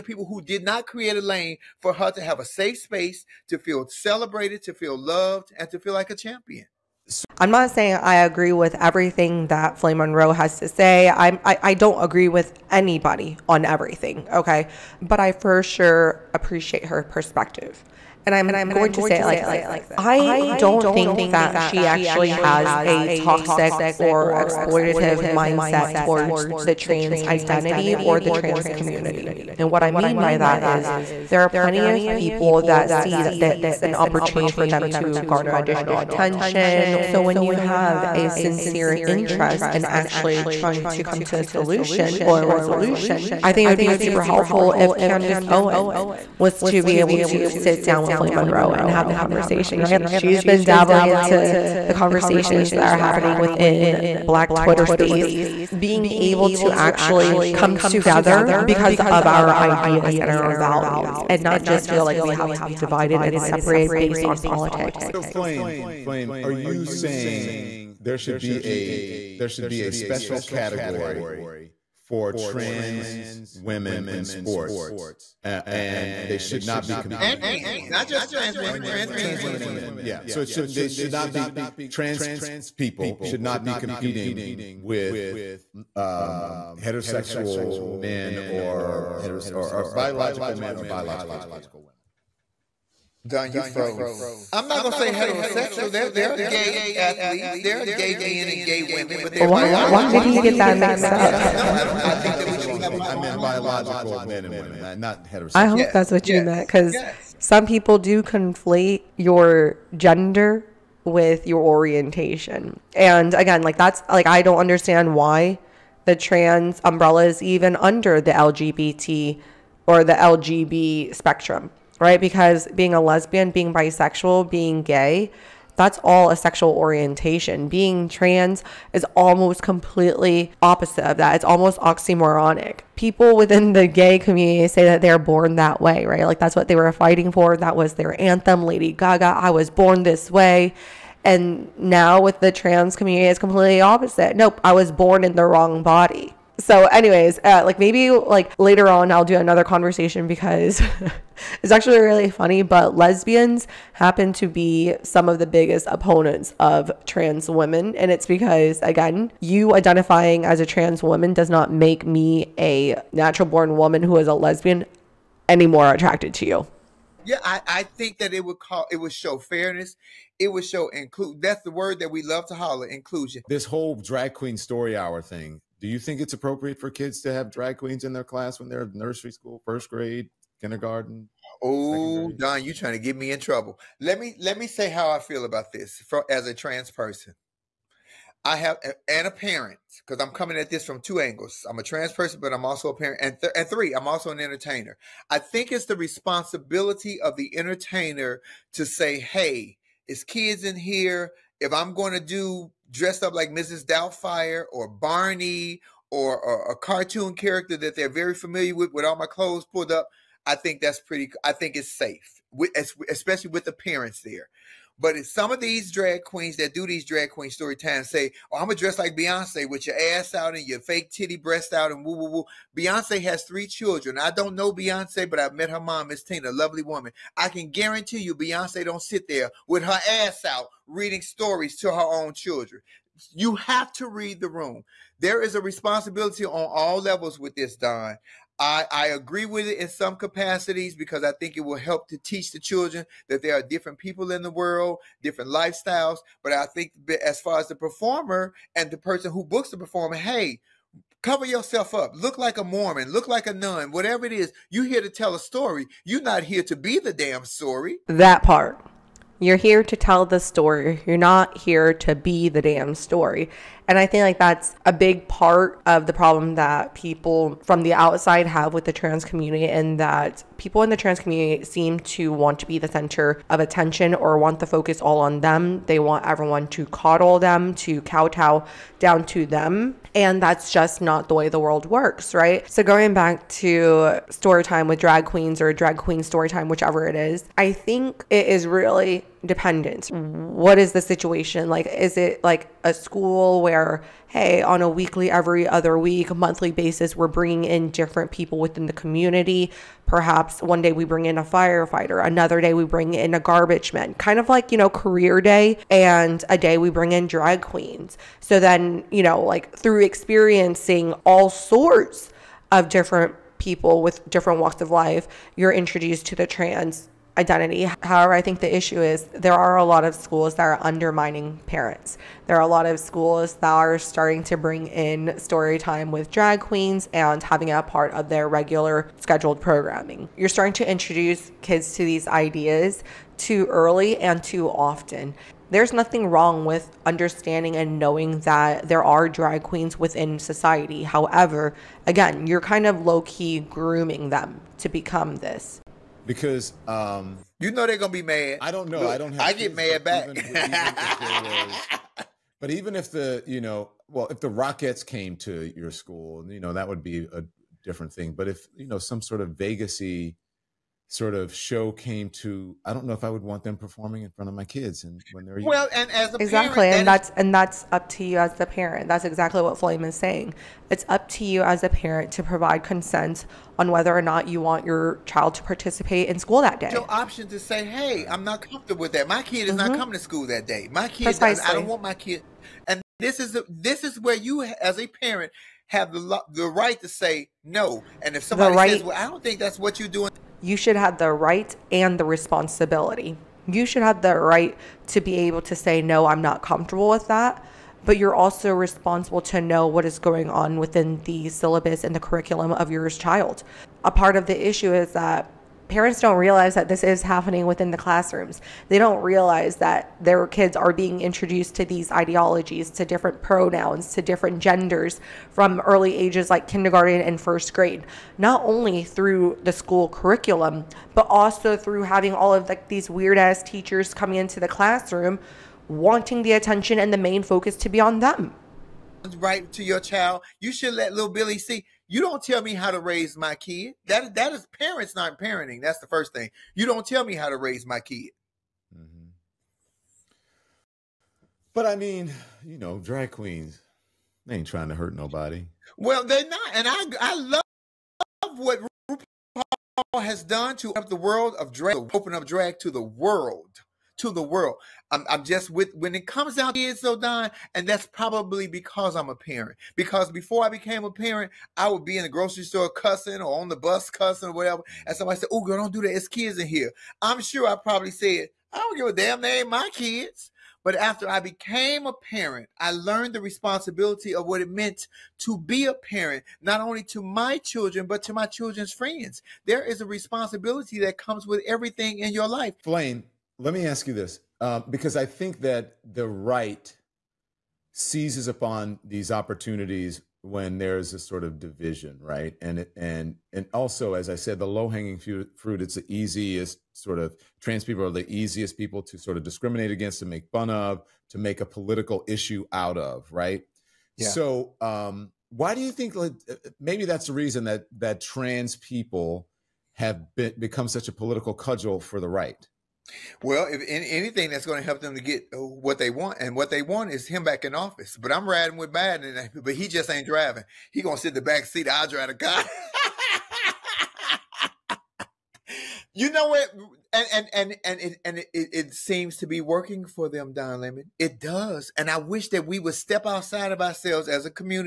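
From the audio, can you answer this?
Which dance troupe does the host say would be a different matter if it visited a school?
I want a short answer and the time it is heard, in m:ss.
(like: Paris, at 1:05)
the Rockets, at 5:54.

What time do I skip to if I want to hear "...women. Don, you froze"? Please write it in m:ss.
1:31.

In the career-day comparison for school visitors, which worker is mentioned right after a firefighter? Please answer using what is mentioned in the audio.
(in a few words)
garbage man.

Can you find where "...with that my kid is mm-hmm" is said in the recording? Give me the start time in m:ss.
6:19.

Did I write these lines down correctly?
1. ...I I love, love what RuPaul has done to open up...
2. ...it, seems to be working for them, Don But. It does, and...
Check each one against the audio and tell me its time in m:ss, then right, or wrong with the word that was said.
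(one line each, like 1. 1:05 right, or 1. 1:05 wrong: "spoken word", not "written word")
1. 7:26 right
2. 8:48 wrong: "Lemon", not "But".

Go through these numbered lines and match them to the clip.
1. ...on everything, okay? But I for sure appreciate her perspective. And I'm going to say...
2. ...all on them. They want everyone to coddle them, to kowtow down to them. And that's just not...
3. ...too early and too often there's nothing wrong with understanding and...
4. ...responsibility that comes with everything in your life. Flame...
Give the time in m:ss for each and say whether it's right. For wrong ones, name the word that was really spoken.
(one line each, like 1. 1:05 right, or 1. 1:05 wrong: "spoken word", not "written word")
1. 0:13 right
2. 4:35 right
3. 5:33 right
4. 8:00 right.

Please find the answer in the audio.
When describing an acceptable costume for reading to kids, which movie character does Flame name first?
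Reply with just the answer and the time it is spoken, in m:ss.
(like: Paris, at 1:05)
Mrs. Doubtfire, at 3:23.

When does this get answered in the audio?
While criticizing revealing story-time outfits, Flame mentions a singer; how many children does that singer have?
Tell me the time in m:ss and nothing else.
3:43.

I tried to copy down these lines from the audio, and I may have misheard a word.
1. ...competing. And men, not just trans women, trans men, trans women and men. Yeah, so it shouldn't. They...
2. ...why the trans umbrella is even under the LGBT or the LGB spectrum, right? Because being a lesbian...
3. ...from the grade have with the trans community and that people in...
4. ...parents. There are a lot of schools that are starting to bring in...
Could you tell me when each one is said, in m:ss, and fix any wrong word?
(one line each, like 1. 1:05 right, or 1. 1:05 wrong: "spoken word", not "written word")
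1. 1:16 right
2. 1:55 right
3. 4:27 wrong: "outside", not "grade"
4. 5:21 right.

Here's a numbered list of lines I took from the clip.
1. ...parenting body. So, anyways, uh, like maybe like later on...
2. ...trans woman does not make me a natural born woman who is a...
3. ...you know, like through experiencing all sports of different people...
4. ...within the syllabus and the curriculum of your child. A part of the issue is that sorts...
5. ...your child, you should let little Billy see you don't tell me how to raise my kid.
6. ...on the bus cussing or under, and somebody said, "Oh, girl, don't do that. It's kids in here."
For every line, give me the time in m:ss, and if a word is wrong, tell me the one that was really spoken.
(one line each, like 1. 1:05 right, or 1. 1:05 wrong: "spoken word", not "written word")
1. 2:25 wrong: "wrong", not "parenting"
2. 2:40 right
3. 5:09 wrong: "sorts", not "sports"
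4. 6:40 wrong: "parents", not "sorts"
5. 7:09 right
6. 7:43 wrong: "whatever", not "under".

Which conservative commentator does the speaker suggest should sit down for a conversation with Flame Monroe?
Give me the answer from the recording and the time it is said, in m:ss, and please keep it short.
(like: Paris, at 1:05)
Candace Owens, at 0:44.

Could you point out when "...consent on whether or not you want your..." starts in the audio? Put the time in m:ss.
6:12.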